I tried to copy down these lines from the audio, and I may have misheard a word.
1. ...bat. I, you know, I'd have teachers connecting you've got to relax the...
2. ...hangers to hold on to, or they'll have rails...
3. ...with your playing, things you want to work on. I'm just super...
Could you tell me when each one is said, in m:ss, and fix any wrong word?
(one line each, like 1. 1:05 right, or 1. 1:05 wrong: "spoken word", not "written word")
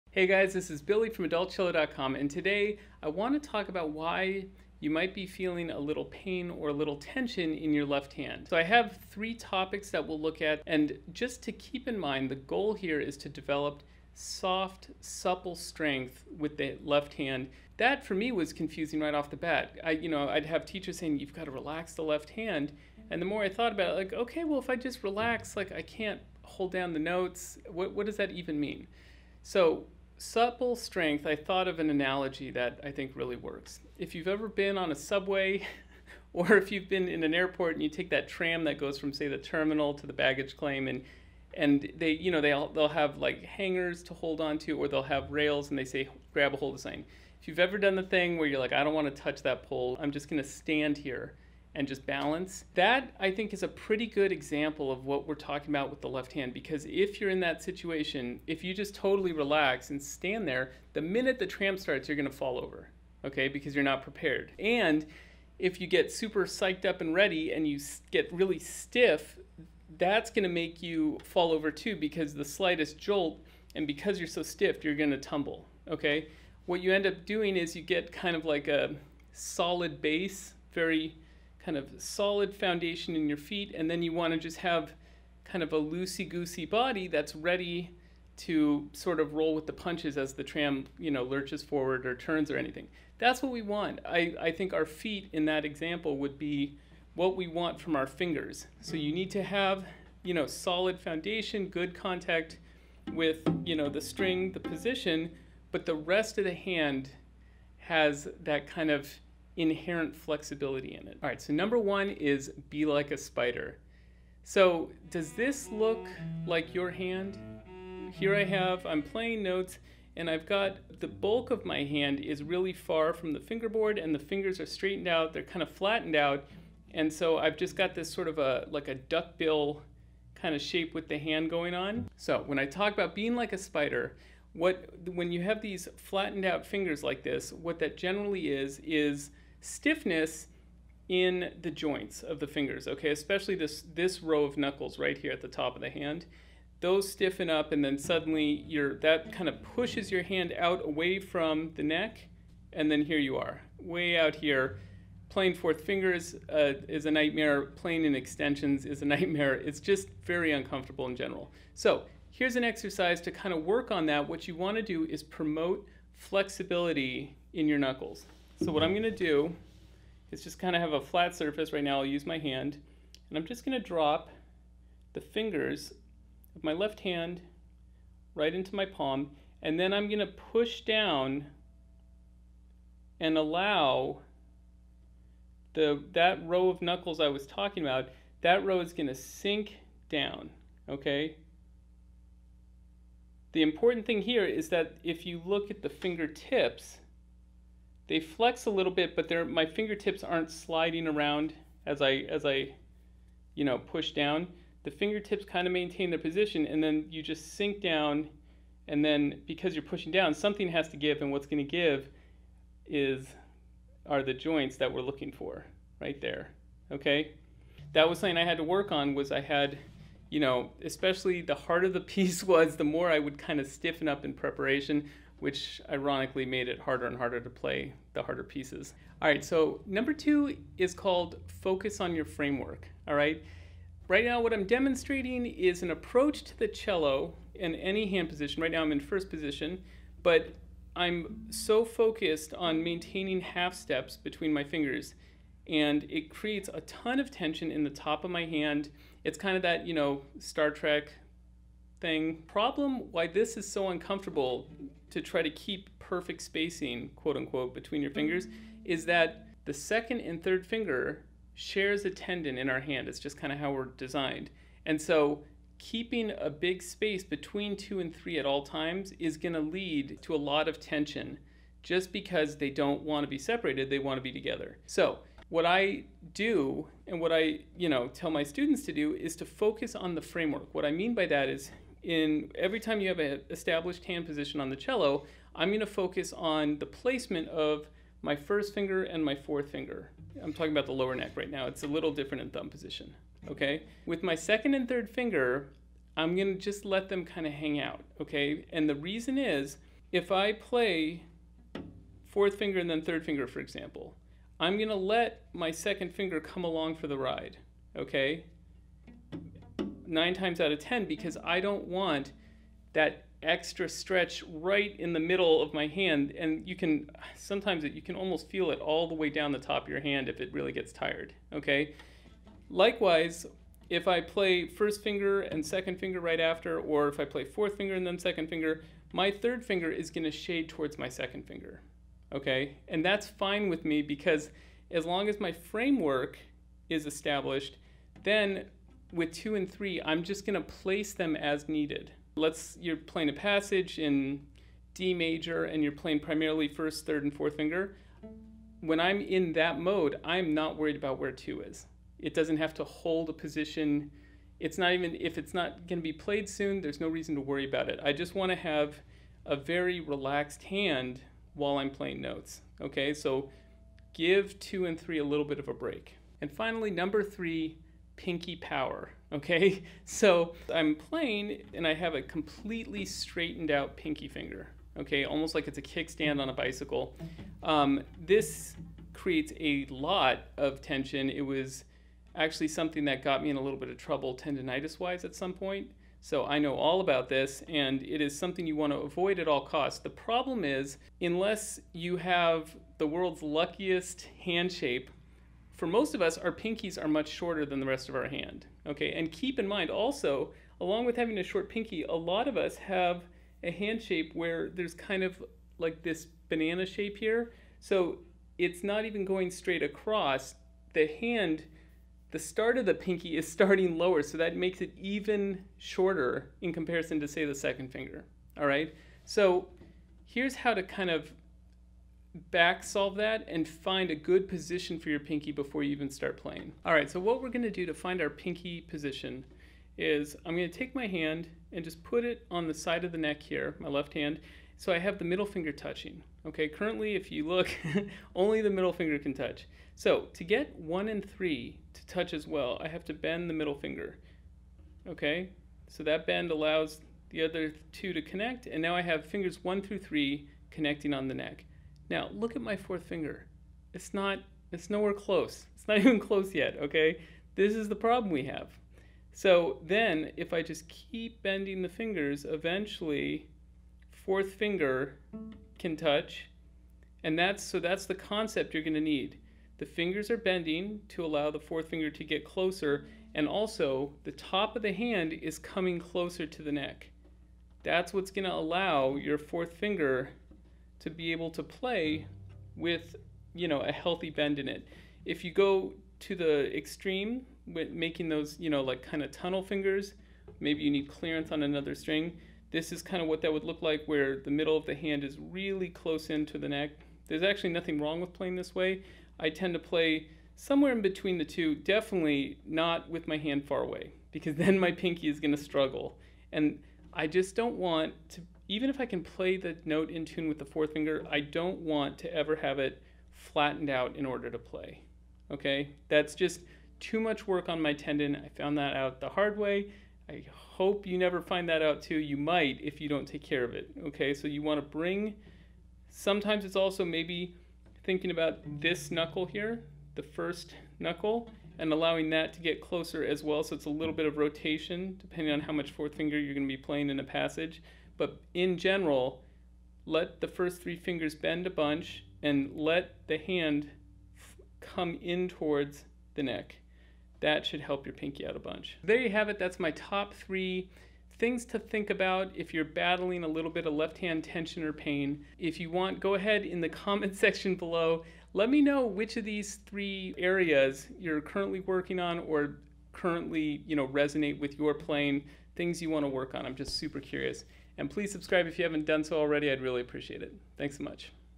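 1. 0:19 wrong: "saying", not "connecting"
2. 0:43 right
3. 9:24 right.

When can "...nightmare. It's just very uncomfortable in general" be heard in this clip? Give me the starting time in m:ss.
2:39.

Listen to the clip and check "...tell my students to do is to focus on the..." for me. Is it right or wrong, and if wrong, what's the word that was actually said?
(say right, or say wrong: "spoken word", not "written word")
right.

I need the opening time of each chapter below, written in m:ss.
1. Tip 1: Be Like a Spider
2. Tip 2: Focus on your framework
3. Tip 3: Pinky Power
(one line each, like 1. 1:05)
1. 1:51
2. 3:50
3. 6:06.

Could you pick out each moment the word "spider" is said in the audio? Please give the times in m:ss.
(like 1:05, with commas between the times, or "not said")
1:53, 2:13.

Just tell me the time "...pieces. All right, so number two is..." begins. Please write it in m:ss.
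3:48.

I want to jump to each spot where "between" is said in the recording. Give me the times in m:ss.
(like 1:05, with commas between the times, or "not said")
4:04, 4:17, 4:27, 8:21.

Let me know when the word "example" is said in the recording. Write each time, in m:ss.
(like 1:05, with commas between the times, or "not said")
0:54, 1:35, 5:03.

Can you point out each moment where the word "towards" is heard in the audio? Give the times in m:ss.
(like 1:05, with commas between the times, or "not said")
5:30, 9:05.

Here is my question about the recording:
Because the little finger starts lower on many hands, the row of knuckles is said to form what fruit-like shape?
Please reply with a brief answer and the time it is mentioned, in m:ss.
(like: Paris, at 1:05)
banana shape, at 6:46.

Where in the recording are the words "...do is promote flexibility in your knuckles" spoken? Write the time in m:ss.
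2:44.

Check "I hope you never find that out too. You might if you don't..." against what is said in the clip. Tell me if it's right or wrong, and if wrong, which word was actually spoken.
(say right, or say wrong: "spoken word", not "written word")
right.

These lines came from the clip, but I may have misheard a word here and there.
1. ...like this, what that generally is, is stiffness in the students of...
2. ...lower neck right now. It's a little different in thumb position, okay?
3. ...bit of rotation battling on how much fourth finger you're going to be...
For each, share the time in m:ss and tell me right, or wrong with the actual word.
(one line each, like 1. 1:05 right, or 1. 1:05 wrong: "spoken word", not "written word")
1. 2:17 wrong: "joints", not "students"
2. 4:50 right
3. 8:54 wrong: "depending", not "battling".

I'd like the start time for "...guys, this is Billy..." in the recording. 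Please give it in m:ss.
0:00.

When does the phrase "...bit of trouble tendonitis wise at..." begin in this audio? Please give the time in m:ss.
6:23.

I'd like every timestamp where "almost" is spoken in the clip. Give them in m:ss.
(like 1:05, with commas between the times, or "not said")
5:18, 6:15.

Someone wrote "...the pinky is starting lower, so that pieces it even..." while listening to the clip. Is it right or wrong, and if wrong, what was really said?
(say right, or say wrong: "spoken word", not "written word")
wrong: "makes", not "pieces".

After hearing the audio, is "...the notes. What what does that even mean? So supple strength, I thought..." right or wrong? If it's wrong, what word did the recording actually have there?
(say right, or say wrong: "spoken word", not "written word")
right.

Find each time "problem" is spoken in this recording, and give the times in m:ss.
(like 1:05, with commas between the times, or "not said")
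4:12, 6:30, 7:37.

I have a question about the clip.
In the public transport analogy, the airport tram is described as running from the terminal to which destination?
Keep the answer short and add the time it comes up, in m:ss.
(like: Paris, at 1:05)
baggage claim, at 0:40.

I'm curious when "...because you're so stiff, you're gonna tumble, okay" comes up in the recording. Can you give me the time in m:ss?
1:13.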